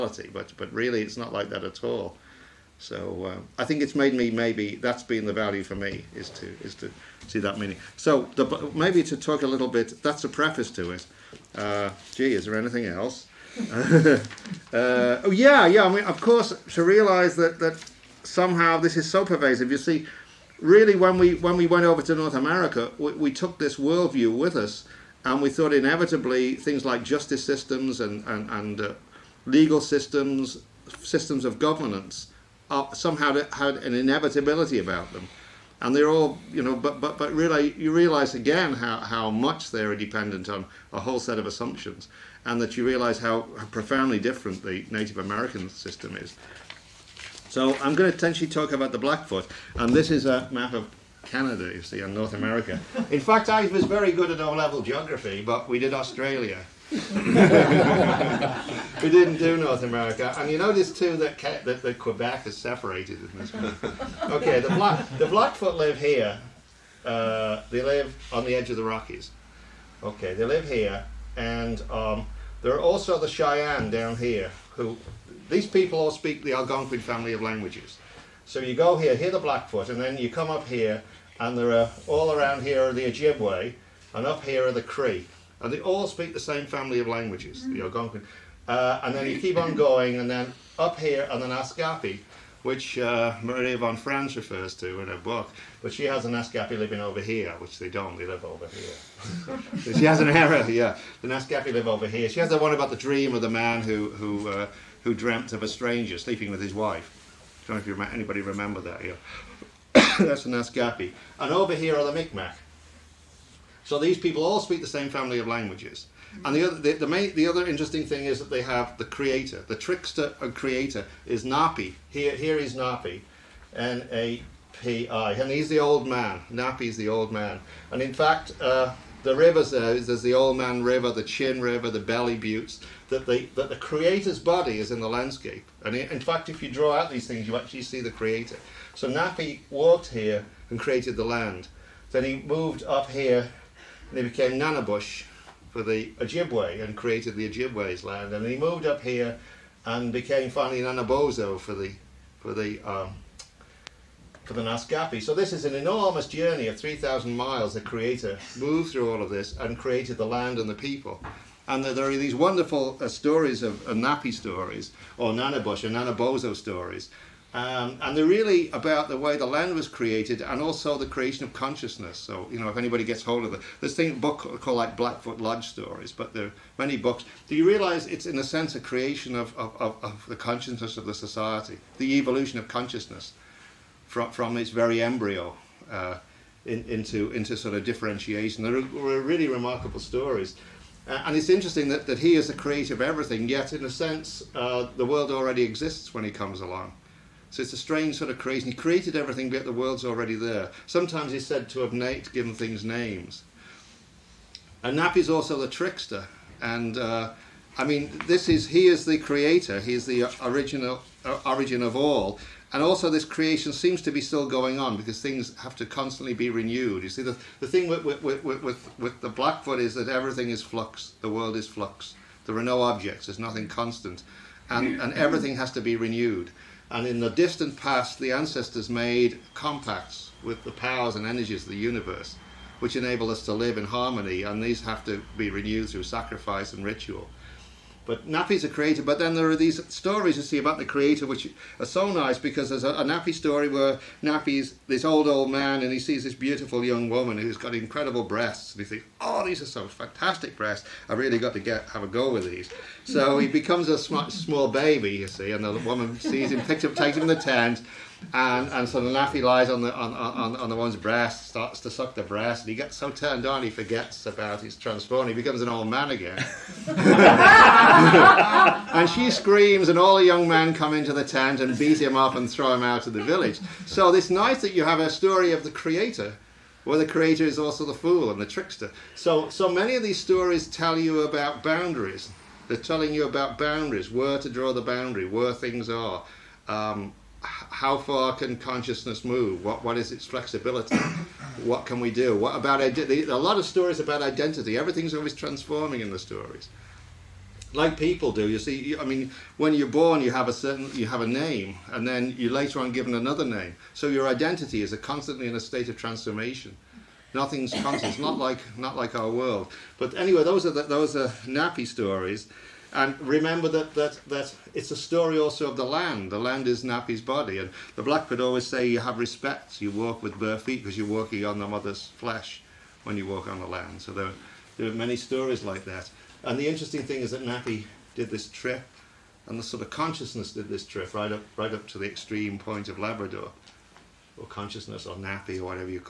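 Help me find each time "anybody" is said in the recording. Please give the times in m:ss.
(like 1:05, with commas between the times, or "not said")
1:48, 2:52.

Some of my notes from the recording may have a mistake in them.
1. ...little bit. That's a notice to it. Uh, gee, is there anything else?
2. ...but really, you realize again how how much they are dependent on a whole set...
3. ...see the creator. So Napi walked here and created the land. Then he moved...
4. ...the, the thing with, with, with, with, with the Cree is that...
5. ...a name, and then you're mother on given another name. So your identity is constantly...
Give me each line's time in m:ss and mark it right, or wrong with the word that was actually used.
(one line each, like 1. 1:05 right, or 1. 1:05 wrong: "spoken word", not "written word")
1. 0:09 wrong: "preface", not "notice"
2. 0:37 right
3. 2:17 right
4. 3:37 wrong: "Blackfoot", not "Cree"
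5. 5:01 wrong: "later", not "mother".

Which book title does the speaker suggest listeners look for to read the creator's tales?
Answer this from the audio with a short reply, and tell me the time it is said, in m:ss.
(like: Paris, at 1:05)
Blackfoot Lodge Stories, at 2:54.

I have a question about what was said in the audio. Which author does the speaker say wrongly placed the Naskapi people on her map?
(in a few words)
Maria von Franz.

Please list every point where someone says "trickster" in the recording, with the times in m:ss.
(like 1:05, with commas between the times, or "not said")
1:59, 3:25, 4:38.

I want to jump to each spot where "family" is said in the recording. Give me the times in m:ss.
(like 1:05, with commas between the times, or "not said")
1:17, 1:26, 1:55.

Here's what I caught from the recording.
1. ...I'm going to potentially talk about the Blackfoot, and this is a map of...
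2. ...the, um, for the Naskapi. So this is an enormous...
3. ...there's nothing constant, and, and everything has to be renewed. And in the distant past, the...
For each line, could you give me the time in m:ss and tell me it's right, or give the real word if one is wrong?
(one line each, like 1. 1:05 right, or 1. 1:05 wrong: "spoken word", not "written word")
1. 0:47 right
2. 2:32 right
3. 3:43 right.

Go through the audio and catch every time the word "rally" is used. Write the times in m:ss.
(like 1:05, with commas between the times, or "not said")
not said.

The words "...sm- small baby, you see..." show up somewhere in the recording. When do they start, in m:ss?
4:13.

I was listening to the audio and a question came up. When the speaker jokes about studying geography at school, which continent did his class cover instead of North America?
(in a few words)
Australia.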